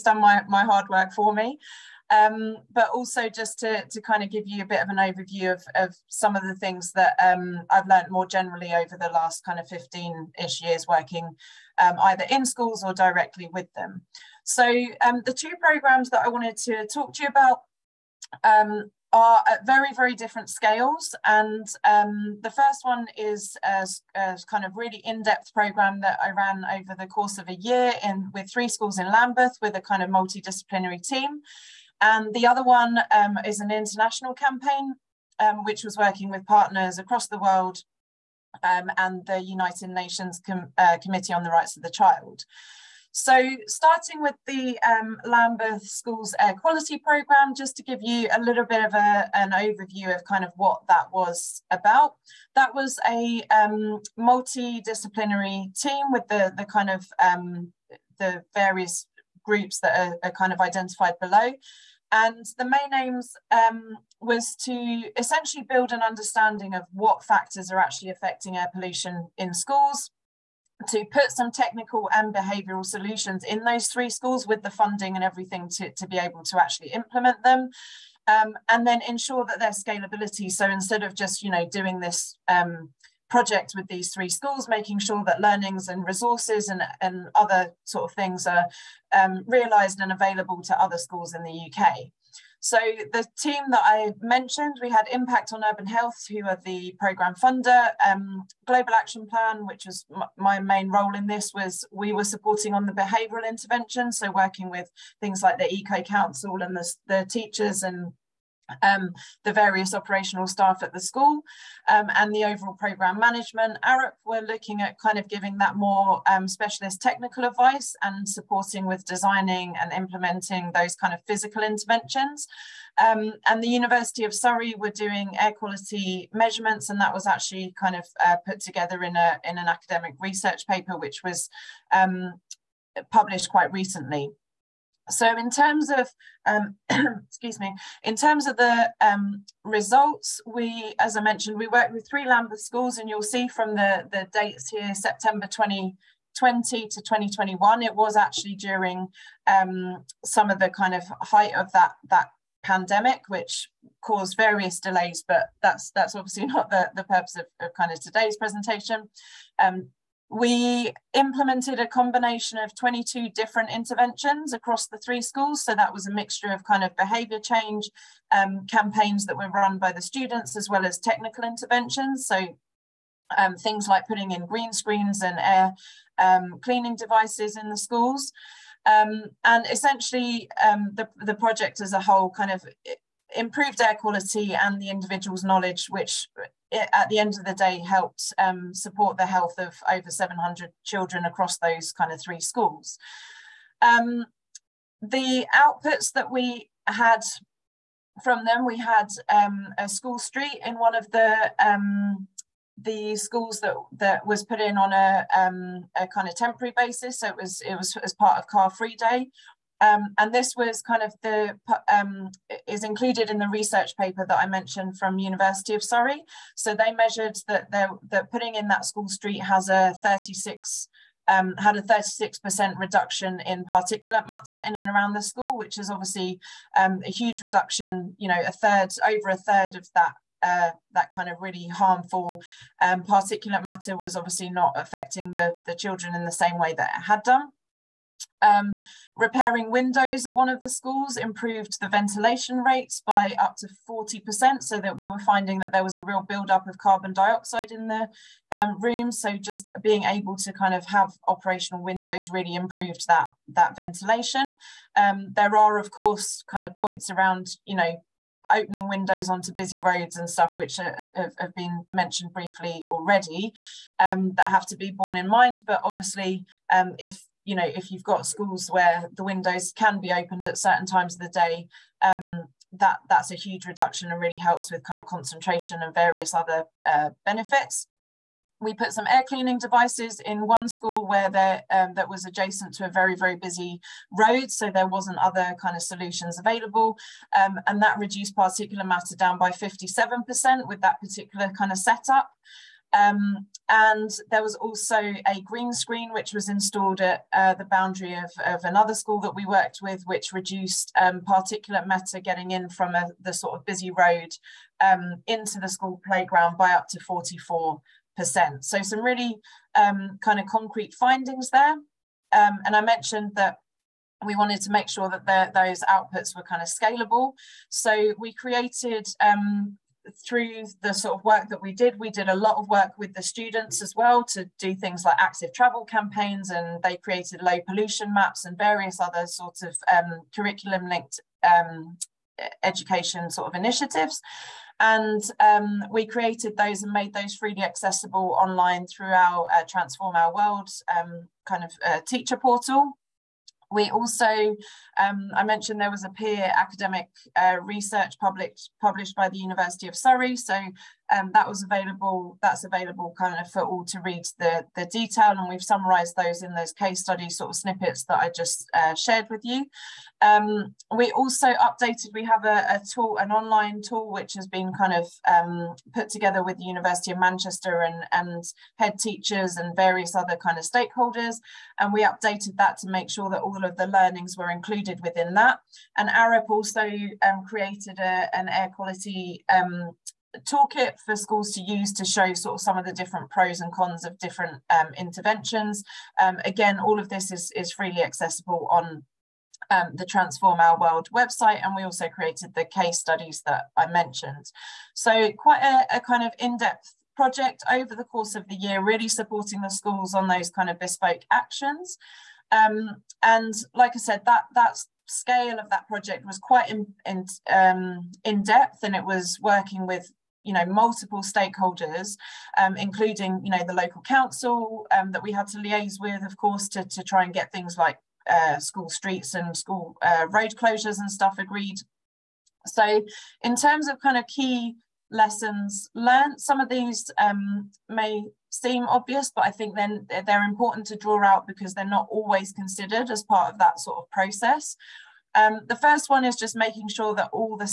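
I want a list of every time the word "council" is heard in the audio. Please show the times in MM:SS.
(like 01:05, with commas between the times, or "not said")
01:46, 06:54.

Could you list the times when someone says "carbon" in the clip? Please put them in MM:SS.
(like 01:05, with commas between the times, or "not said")
04:06.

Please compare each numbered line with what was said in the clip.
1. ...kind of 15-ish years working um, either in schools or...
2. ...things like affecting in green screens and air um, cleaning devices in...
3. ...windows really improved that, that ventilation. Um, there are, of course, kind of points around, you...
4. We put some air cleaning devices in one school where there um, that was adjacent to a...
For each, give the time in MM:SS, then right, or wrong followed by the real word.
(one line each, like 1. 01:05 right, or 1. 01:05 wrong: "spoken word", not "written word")
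1. 00:09 right
2. 02:53 wrong: "putting", not "affecting"
3. 04:11 right
4. 04:38 right.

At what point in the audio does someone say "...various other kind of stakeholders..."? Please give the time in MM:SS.
06:09.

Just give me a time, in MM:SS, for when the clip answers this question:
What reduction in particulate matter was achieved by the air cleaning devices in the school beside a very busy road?
04:49.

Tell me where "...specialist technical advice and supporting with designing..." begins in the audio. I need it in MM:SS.
01:56.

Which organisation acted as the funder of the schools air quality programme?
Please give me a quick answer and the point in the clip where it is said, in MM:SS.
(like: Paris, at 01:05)
Impact on Urban Health, at 01:35.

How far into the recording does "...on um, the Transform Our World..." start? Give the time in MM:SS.
06:28.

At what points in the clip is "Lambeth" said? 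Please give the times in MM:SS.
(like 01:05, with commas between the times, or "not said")
00:29, 00:45, 02:22.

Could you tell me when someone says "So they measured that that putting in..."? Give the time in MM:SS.
03:36.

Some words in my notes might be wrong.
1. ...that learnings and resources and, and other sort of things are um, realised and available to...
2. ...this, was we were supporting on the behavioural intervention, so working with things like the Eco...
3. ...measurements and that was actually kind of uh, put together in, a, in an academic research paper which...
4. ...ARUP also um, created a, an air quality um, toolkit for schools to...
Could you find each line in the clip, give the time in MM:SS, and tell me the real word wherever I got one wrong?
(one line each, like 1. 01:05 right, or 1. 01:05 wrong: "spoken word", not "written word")
1. 01:25 right
2. 01:41 right
3. 02:06 right
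4. 06:16 right.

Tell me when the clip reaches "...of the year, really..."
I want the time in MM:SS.
06:38.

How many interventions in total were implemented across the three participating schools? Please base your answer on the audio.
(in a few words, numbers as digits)
22.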